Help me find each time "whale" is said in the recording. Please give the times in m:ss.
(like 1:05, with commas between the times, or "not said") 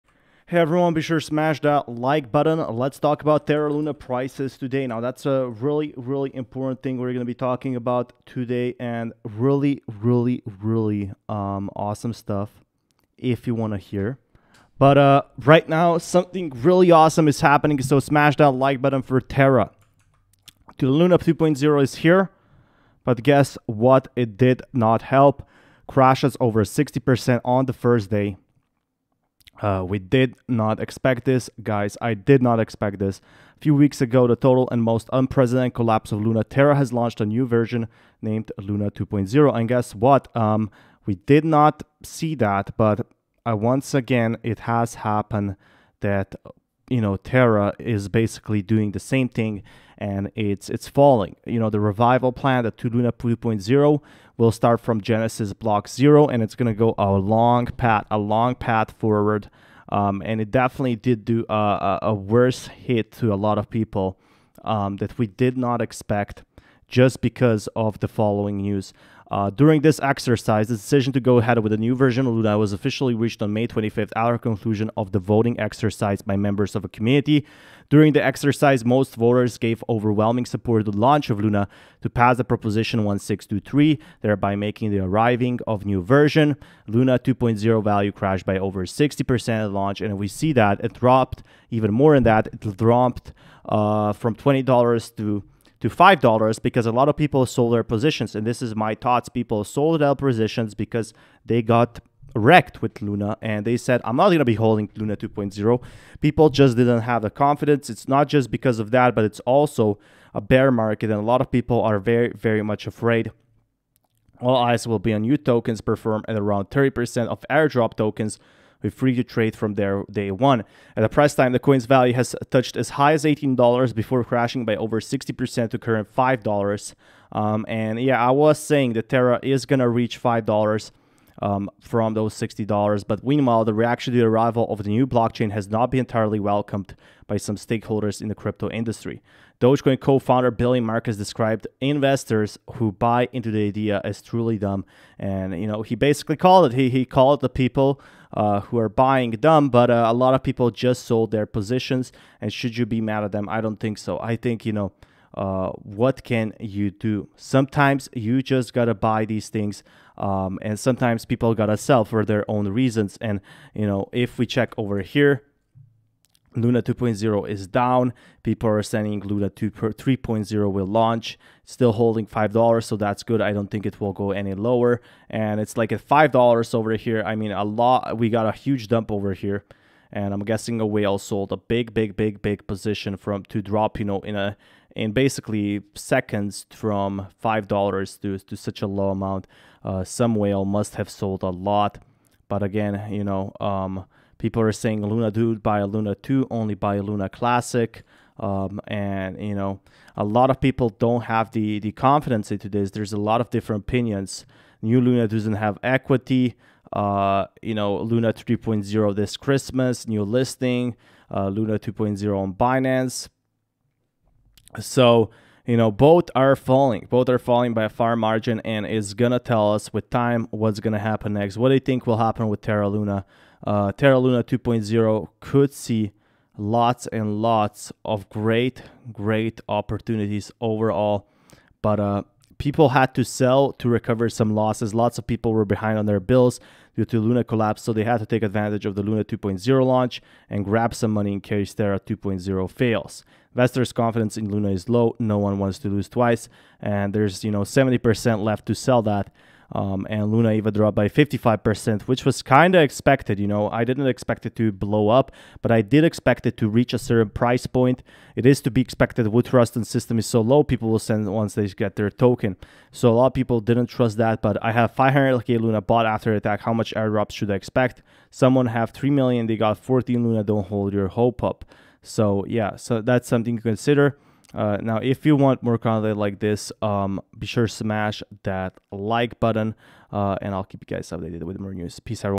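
3:00, 3:10.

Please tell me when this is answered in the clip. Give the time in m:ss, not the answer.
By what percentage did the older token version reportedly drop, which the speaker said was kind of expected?
4:11.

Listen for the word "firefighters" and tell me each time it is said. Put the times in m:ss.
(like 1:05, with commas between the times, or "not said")
not said.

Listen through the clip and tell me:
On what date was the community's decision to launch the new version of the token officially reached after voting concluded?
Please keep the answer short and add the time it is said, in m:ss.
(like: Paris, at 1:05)
May 25th, at 1:13.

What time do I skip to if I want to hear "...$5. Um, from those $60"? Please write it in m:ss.
2:10.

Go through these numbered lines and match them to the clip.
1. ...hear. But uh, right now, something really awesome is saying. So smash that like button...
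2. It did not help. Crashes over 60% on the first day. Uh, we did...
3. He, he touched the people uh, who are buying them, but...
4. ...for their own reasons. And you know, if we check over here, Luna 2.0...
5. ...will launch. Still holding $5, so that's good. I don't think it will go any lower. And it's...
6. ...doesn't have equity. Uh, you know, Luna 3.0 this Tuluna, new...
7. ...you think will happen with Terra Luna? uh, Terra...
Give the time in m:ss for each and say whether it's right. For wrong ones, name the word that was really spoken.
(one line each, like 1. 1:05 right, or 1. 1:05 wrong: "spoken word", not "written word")
1. 0:13 wrong: "happening", not "saying"
2. 0:24 right
3. 2:26 wrong: "called", not "touched"
4. 2:42 right
5. 2:50 right
6. 3:25 wrong: "Christmas", not "Tuluna"
7. 3:41 right.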